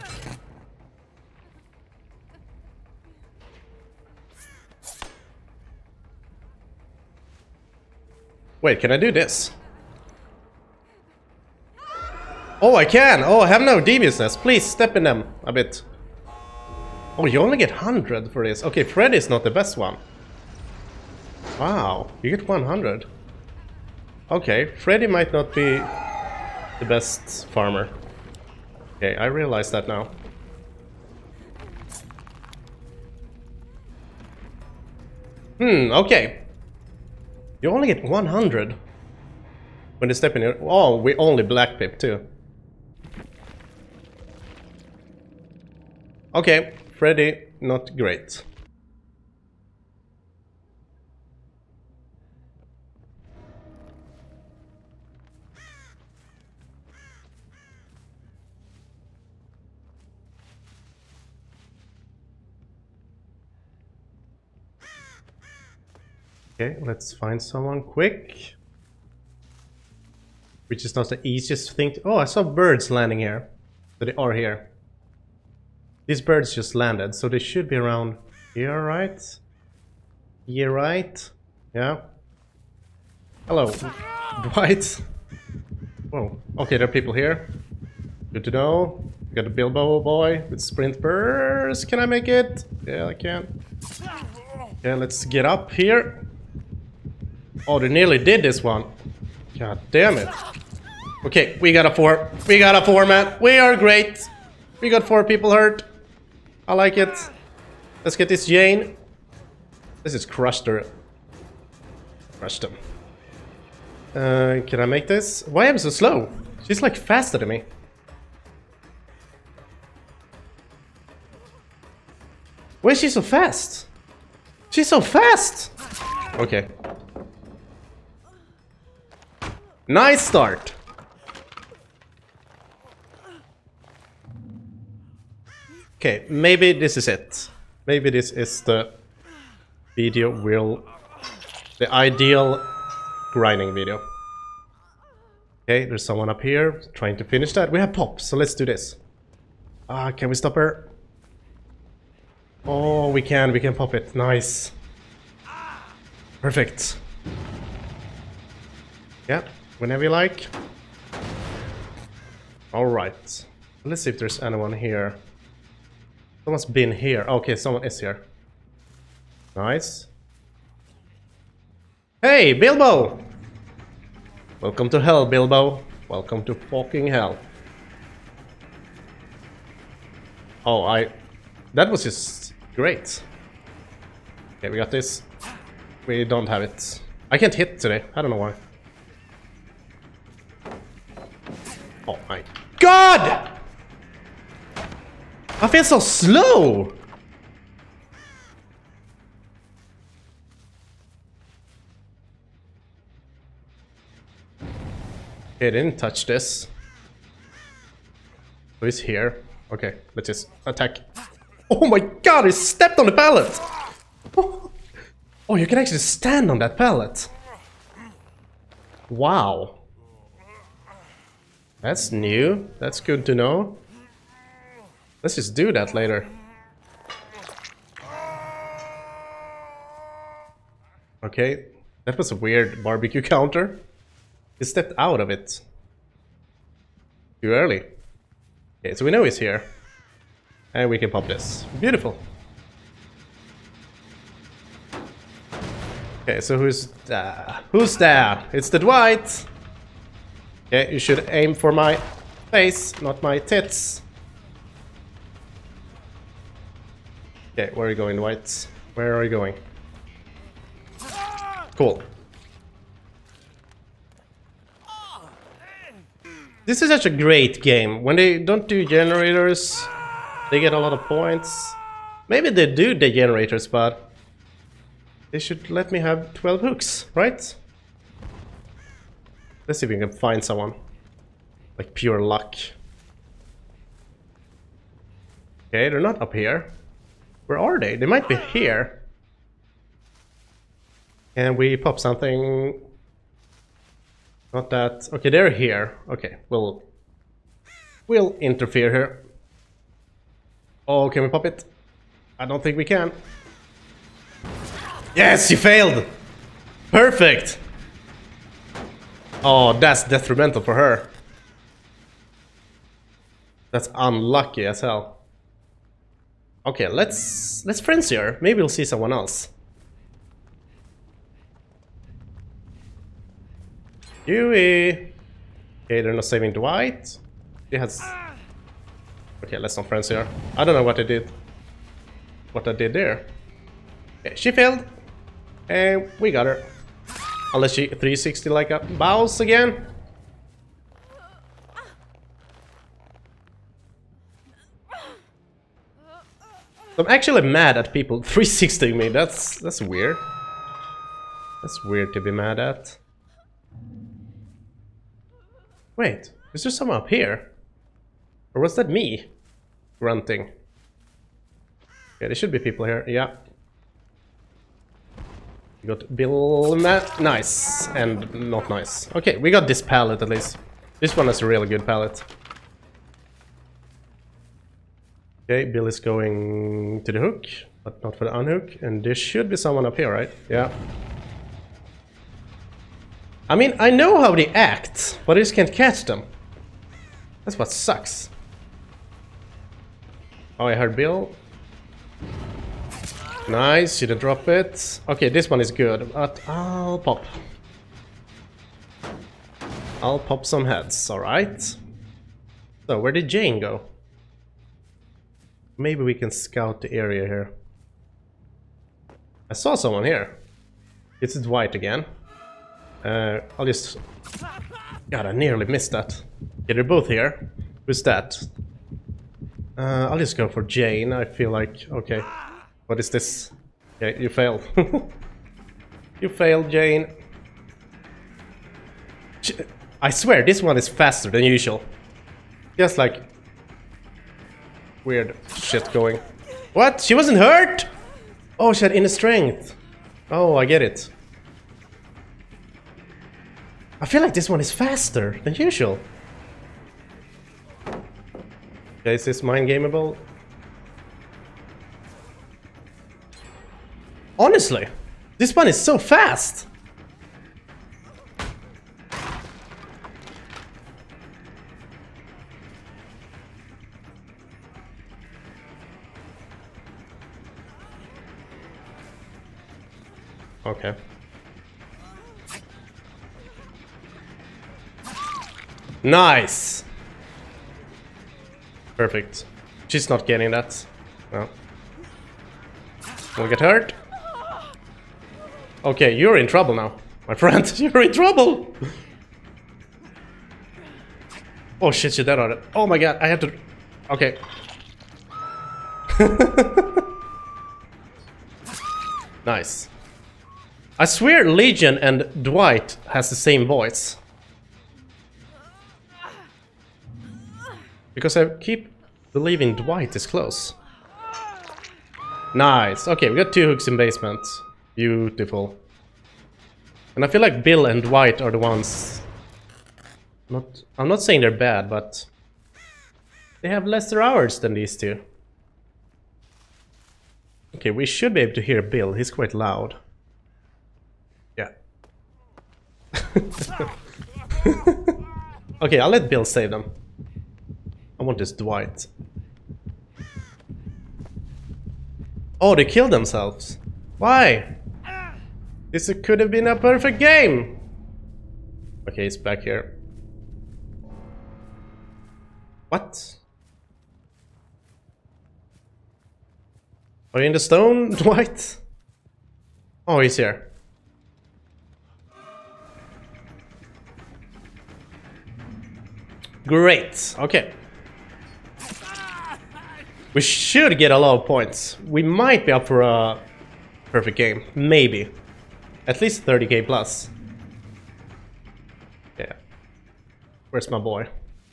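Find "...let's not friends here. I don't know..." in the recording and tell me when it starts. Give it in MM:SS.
05:29.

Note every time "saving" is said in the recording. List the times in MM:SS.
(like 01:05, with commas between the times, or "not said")
05:26.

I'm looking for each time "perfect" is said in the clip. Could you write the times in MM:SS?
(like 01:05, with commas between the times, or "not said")
02:36, 05:06, 07:58, 09:06, 09:34.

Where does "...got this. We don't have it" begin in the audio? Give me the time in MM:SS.
03:04.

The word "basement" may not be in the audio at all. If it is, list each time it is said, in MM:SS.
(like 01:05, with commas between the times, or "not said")
08:33.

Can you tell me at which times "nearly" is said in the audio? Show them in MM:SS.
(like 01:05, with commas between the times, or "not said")
01:37, 06:55.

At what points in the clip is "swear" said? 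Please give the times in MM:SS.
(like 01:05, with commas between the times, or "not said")
07:10, 08:21.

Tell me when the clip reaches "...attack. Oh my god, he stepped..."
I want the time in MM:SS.
03:30.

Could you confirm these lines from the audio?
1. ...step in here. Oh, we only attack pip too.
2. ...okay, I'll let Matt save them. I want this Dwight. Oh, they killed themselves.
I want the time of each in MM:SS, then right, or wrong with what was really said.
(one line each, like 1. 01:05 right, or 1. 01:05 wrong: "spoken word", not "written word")
1. 00:40 wrong: "black", not "attack"
2. 08:55 wrong: "Bill", not "Matt".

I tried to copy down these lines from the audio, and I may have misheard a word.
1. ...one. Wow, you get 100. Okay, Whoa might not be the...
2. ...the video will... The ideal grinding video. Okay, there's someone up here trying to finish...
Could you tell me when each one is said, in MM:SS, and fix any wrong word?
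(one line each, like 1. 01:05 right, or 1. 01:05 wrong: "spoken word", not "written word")
1. 00:19 wrong: "Freddy", not "Whoa"
2. 02:18 right.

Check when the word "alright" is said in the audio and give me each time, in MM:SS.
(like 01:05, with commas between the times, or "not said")
02:42, 06:41.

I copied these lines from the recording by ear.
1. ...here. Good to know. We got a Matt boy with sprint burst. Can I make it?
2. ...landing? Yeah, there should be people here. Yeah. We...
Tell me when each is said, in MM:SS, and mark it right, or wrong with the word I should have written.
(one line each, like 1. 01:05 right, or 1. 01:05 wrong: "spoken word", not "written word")
1. 01:27 wrong: "Bilbo", not "Matt"
2. 05:59 wrong: "grunting", not "landing".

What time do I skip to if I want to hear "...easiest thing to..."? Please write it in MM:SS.
01:11.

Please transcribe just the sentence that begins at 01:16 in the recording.
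These birds just landed, so they should be around here, right?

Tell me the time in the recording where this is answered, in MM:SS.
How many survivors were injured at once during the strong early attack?
01:45.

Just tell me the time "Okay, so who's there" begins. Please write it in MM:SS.
04:06.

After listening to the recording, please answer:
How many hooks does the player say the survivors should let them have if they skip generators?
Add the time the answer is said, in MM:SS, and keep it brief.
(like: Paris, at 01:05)
12, at 04:36.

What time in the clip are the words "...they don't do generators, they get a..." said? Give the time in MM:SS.
04:28.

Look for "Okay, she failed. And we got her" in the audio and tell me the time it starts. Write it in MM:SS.
05:34.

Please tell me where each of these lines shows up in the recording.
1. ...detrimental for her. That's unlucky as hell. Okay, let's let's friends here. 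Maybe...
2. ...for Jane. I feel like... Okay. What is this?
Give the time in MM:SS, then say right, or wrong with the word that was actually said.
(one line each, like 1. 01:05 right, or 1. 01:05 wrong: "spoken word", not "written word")
1. 05:10 right
2. 07:00 right.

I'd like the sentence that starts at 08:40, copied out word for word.
Not, I'm not saying they're bad, but...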